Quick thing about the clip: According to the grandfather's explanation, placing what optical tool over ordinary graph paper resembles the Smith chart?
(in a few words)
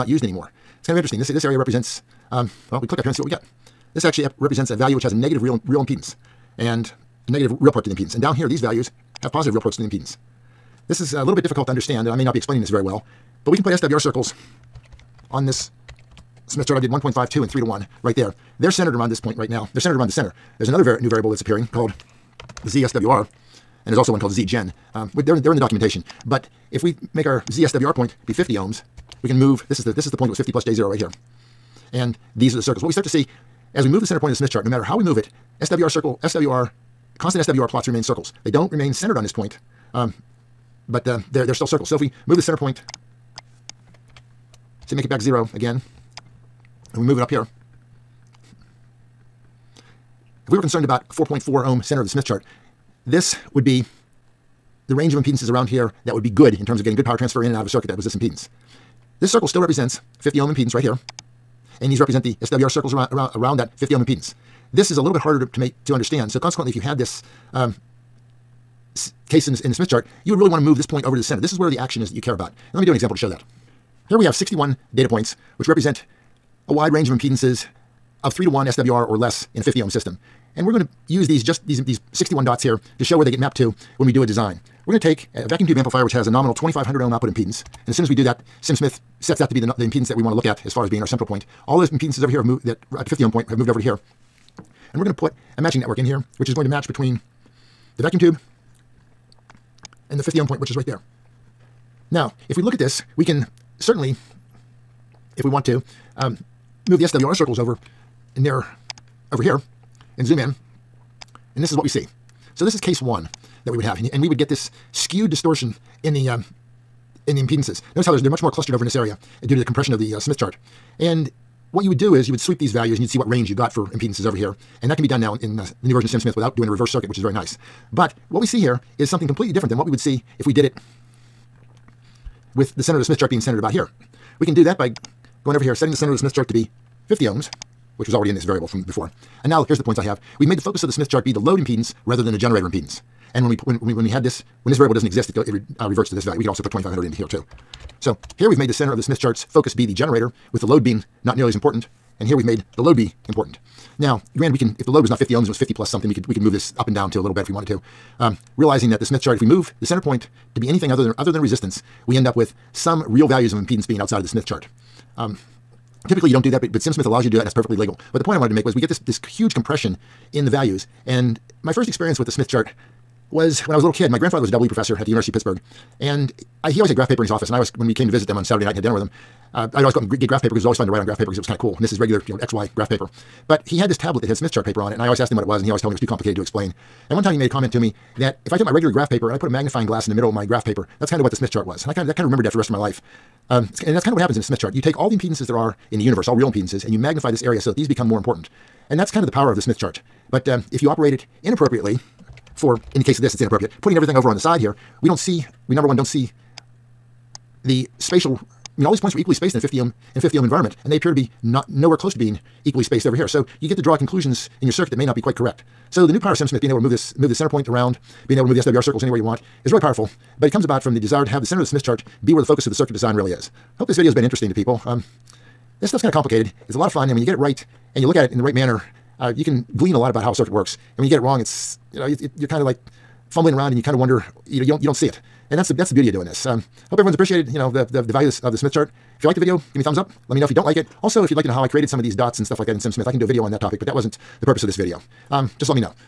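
magnifying glass.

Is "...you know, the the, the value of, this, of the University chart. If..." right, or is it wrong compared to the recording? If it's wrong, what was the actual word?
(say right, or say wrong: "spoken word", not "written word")
wrong: "Smith", not "University".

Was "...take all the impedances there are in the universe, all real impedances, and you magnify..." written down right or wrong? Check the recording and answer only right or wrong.
right.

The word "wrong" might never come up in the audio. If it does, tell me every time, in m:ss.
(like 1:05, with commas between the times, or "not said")
3:51.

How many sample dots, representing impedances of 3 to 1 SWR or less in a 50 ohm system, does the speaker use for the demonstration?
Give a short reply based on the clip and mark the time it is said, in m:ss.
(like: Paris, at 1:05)
61, at 1:14.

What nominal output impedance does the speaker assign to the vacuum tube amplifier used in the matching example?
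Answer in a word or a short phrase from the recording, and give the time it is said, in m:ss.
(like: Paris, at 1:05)
2500 ohms, at 1:26.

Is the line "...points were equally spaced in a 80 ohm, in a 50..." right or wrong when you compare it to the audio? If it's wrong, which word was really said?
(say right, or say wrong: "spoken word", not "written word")
wrong: "50", not "80".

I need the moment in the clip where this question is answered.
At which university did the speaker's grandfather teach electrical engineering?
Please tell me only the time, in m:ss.
2:55.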